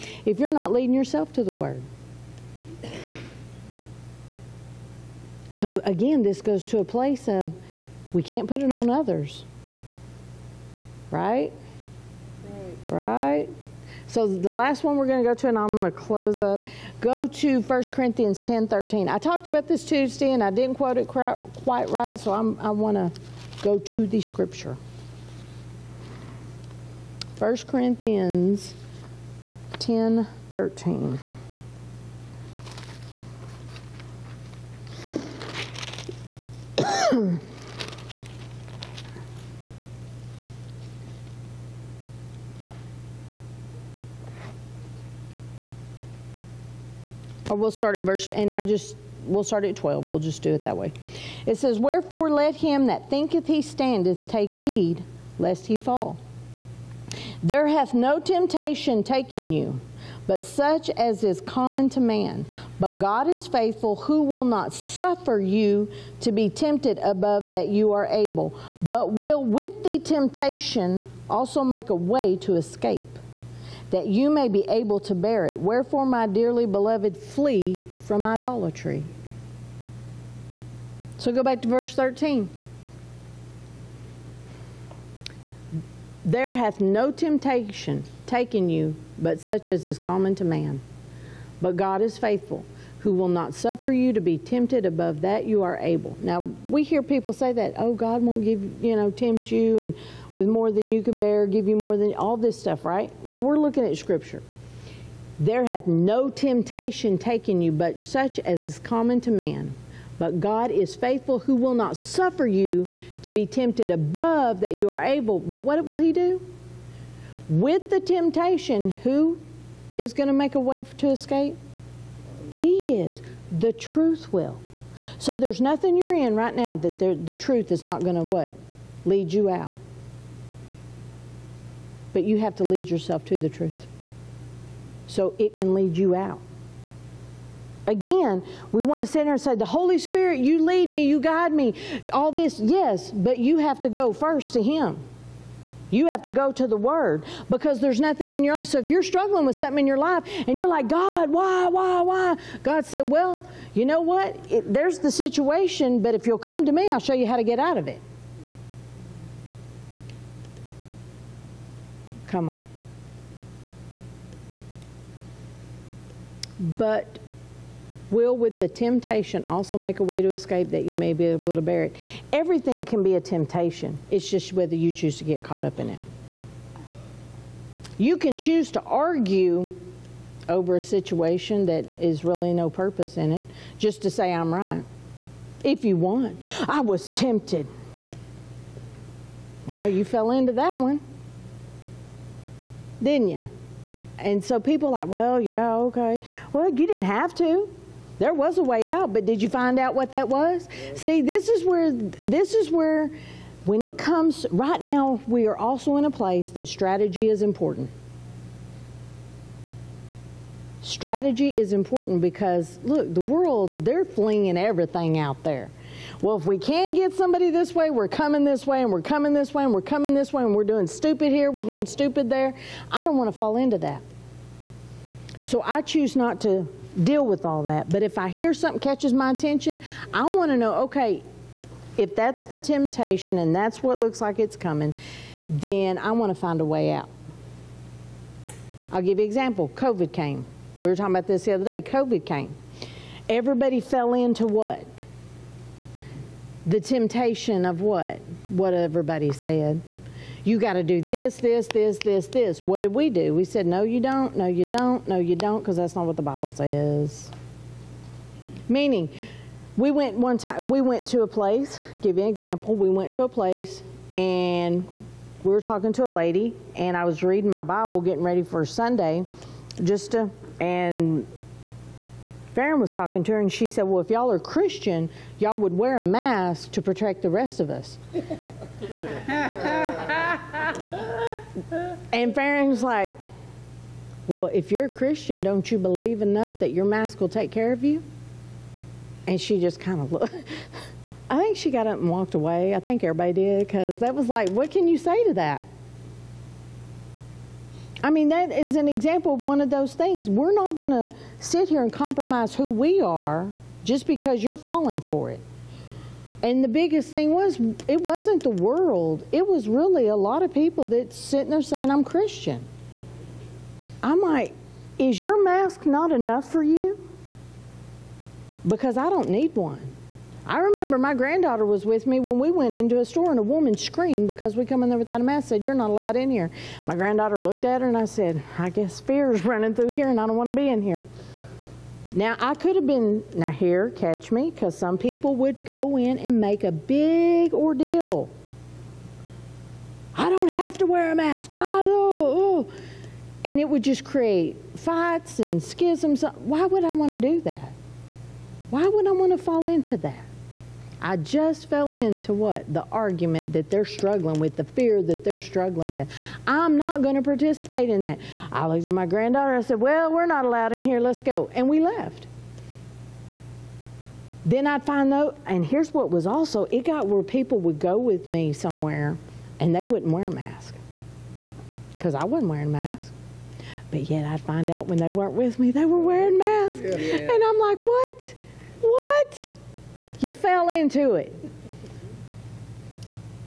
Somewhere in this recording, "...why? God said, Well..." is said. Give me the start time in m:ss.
2:32.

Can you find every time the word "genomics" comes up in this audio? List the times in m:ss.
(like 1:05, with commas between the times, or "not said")
not said.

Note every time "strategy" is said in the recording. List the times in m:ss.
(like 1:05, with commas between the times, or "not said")
3:26, 3:30.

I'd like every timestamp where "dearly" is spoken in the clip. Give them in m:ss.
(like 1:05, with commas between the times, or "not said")
1:16.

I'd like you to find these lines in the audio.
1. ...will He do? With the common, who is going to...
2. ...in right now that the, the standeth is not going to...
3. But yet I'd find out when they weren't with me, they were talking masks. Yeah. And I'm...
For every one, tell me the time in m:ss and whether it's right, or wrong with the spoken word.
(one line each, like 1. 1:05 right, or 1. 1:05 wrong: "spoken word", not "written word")
1. 1:55 wrong: "temptation", not "common"
2. 2:06 wrong: "truth", not "standeth"
3. 6:13 wrong: "wearing", not "talking".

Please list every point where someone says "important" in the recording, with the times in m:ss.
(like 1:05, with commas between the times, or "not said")
3:27, 3:31.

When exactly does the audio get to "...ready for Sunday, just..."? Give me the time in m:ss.
4:28.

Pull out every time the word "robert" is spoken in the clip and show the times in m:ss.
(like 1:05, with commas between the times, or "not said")
not said.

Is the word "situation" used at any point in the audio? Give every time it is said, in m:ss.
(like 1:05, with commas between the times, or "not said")
2:35, 3:00.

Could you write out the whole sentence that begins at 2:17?
Again, we want to sit here and say, the Holy Spirit, you lead me, you guide me, all this.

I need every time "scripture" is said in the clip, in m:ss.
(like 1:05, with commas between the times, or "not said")
0:24, 1:43.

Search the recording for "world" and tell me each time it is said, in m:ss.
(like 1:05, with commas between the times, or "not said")
3:33, 5:08.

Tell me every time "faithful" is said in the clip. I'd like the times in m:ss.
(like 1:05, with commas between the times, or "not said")
1:03, 1:32, 1:50.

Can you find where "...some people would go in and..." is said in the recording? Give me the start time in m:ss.
5:34.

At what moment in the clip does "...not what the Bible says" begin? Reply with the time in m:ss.
4:15.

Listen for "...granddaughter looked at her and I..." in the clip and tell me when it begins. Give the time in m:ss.
5:26.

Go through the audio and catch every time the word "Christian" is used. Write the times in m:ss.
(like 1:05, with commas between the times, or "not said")
4:34, 4:44, 5:12.